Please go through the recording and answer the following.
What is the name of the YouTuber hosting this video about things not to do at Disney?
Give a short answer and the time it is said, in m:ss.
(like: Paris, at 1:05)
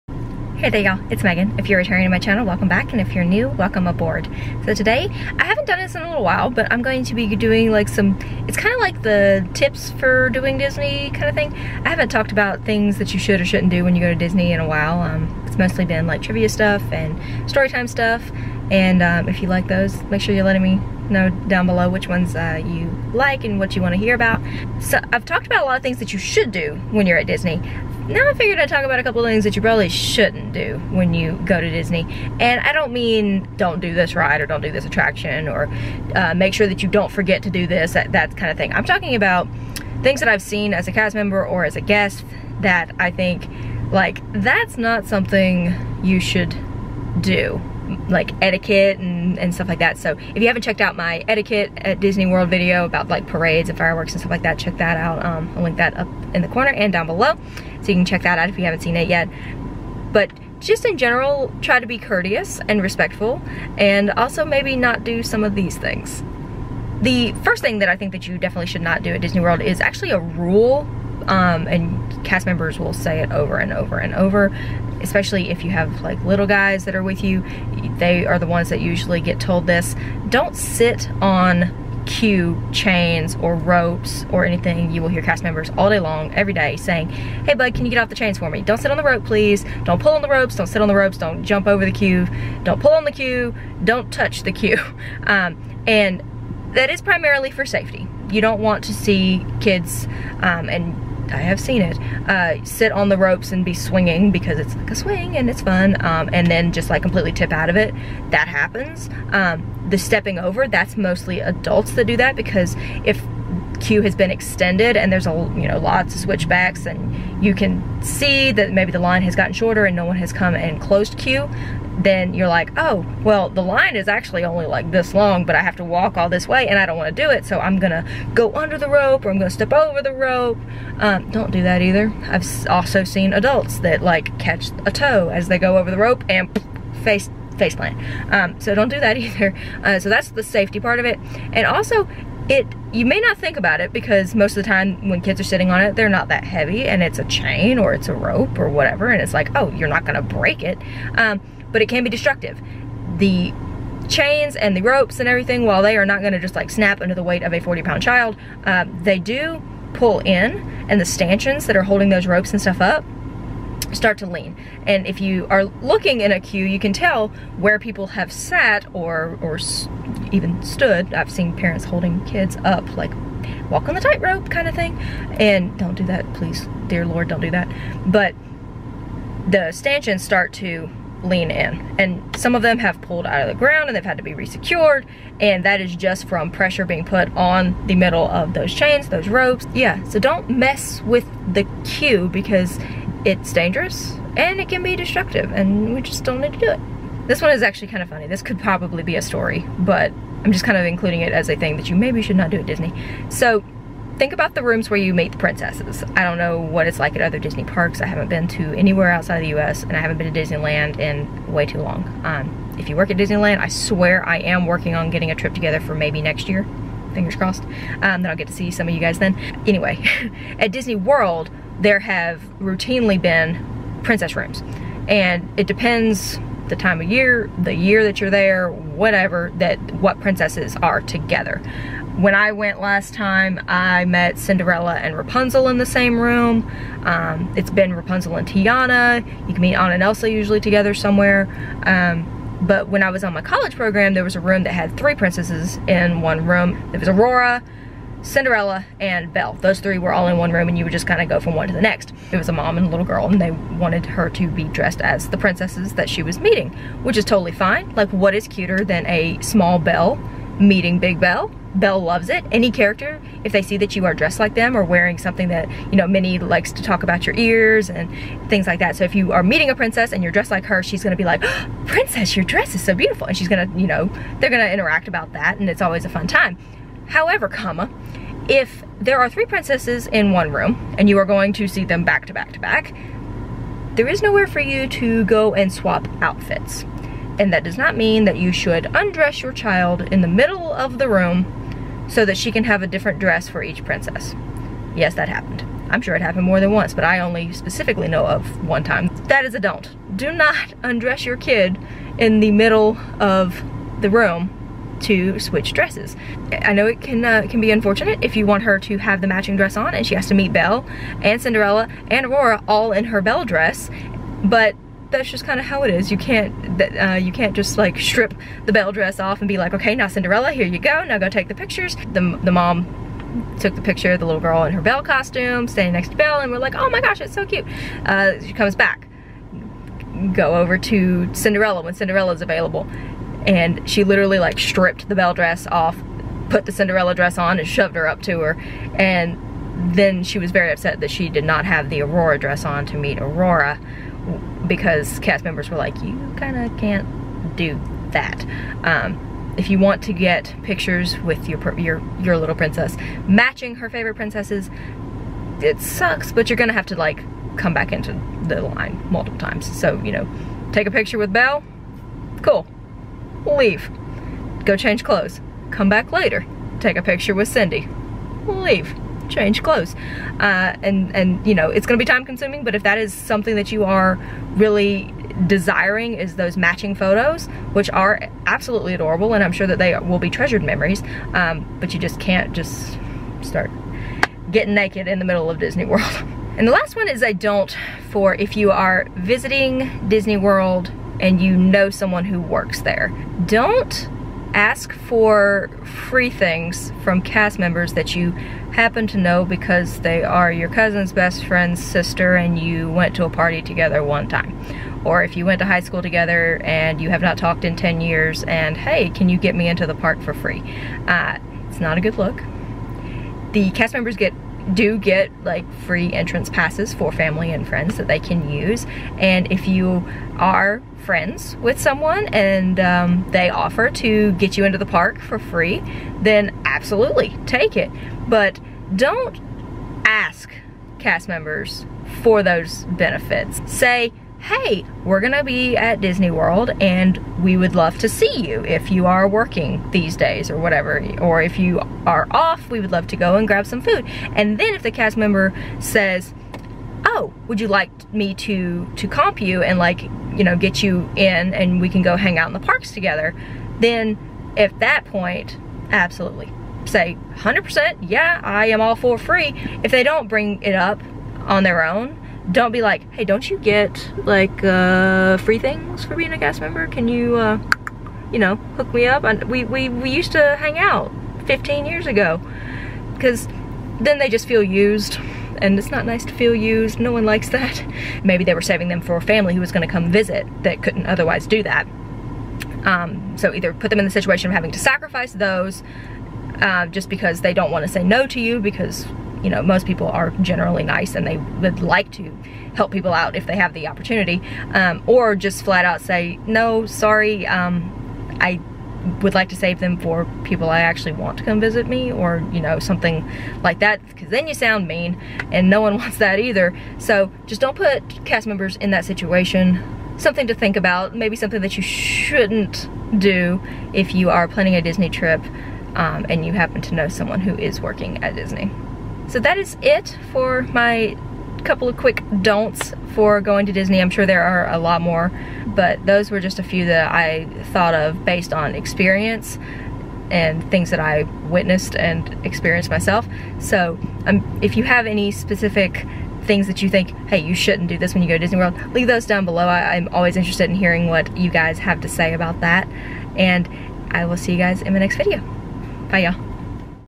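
Meaghan, at 0:01.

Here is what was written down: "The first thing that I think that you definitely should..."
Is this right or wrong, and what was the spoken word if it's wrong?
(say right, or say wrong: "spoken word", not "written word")
right.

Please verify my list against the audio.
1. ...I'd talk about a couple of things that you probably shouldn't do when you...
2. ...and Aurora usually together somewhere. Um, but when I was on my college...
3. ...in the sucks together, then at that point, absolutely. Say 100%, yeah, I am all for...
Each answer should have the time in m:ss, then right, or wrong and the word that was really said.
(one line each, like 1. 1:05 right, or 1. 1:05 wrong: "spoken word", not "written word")
1. 0:28 right
2. 3:59 wrong: "Elsa", not "Aurora"
3. 7:32 wrong: "parks", not "sucks".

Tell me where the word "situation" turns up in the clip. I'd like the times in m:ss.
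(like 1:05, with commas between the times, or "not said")
8:04, 8:29.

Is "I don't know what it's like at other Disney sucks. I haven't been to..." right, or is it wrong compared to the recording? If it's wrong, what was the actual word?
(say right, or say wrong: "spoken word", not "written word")
wrong: "parks", not "sucks".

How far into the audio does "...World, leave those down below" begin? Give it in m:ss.
8:58.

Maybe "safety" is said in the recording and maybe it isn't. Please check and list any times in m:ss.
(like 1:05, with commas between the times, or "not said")
1:37, 2:20.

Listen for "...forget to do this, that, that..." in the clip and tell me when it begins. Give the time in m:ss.
0:37.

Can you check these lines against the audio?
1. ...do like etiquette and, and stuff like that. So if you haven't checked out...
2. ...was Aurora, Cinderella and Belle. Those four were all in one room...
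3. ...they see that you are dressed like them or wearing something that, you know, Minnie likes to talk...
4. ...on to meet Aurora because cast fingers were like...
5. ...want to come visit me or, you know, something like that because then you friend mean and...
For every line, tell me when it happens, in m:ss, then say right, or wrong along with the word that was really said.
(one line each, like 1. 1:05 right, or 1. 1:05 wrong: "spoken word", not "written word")
1. 0:47 right
2. 4:06 wrong: "three", not "four"
3. 4:23 right
4. 5:42 wrong: "members", not "fingers"
5. 8:21 wrong: "sound", not "friend".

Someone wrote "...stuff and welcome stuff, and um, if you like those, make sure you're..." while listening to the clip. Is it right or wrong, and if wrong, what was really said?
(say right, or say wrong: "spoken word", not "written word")
wrong: "storytime", not "welcome".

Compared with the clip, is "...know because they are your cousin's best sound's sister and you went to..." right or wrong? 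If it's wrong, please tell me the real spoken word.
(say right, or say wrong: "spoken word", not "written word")
wrong: "friend", not "sound".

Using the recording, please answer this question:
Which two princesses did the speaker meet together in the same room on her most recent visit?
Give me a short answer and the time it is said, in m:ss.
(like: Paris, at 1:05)
Cinderella and Rapunzel, at 3:54.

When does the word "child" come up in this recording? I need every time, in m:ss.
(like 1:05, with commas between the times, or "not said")
2:38, 4:49.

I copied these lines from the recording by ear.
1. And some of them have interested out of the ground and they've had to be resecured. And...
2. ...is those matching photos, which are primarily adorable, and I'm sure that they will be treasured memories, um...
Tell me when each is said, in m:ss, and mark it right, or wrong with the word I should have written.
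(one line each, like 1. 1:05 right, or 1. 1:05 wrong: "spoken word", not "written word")
1. 3:01 wrong: "pulled", not "interested"
2. 6:16 wrong: "absolutely", not "primarily".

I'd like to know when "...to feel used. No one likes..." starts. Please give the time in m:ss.
7:56.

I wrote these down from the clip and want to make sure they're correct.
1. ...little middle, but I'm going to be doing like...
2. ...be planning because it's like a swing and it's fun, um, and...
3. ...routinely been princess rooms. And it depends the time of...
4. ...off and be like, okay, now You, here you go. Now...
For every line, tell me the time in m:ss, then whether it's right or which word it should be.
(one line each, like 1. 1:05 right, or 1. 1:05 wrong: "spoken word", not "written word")
1. 0:06 wrong: "while", not "middle"
2. 1:43 wrong: "swinging", not "planning"
3. 3:42 right
4. 5:19 wrong: "Cinderella", not "You".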